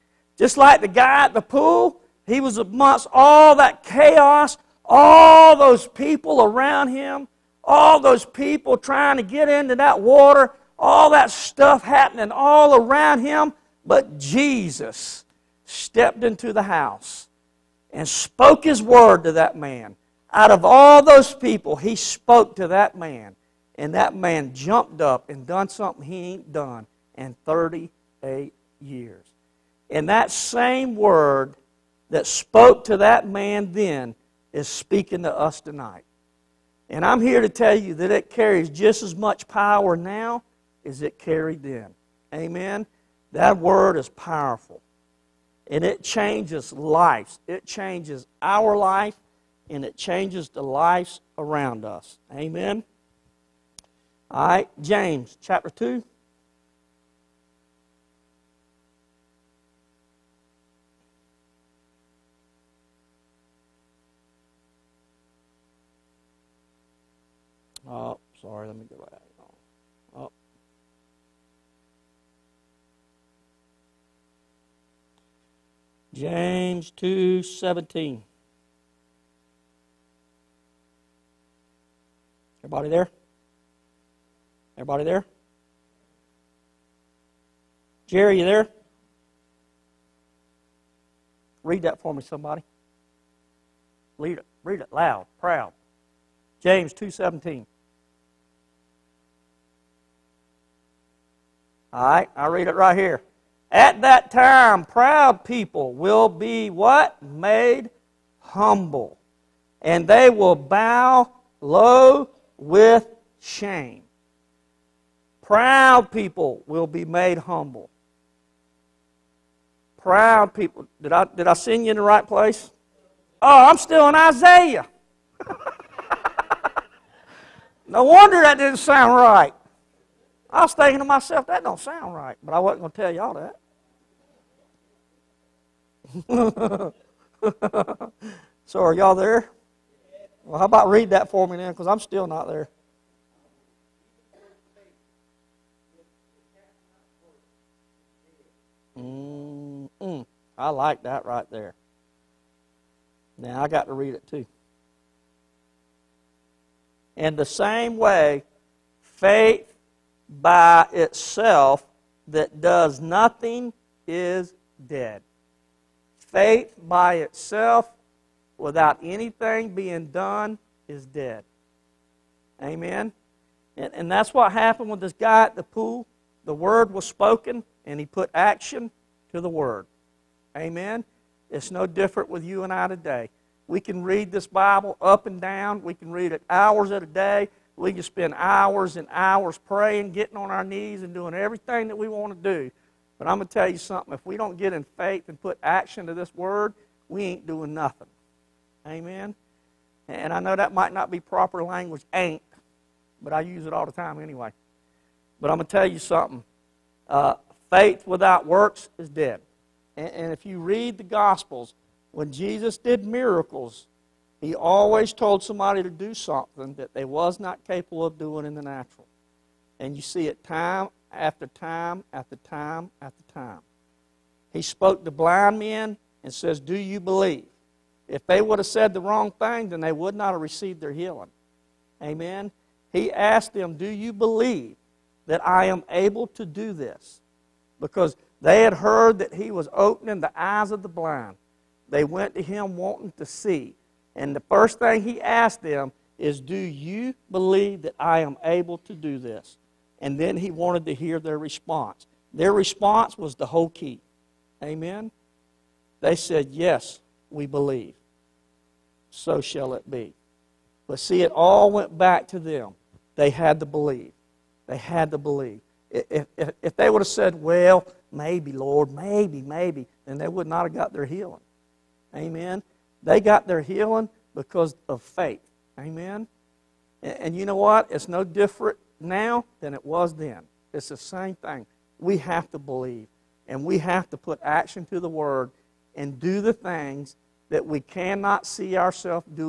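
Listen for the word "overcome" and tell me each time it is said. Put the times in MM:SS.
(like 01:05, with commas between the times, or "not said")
not said.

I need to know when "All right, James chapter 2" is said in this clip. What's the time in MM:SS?
00:54.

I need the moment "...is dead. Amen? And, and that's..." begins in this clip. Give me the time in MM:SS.
02:50.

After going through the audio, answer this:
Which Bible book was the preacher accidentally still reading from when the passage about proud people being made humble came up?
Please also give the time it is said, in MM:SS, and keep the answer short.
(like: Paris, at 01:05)
Isaiah, at 02:04.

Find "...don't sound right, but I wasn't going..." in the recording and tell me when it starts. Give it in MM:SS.
02:11.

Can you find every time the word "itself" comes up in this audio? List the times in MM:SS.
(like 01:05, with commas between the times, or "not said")
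02:40, 02:47.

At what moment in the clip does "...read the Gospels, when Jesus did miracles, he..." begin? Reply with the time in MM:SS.
03:30.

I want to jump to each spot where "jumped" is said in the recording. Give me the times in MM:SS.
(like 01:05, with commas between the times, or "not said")
00:24.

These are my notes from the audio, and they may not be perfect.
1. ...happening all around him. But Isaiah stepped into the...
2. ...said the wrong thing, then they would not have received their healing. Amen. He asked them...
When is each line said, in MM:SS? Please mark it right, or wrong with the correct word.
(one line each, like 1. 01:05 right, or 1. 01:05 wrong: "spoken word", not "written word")
1. 00:11 wrong: "Jesus", not "Isaiah"
2. 03:48 right.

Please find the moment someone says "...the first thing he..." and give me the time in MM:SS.
04:04.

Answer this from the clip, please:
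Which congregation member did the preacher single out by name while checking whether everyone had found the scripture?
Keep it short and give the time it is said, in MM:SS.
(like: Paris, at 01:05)
Jerry, at 01:28.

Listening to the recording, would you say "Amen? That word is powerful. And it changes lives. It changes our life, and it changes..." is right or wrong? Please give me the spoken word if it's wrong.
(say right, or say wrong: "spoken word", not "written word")
right.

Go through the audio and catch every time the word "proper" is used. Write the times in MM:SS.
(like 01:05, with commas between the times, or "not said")
03:21.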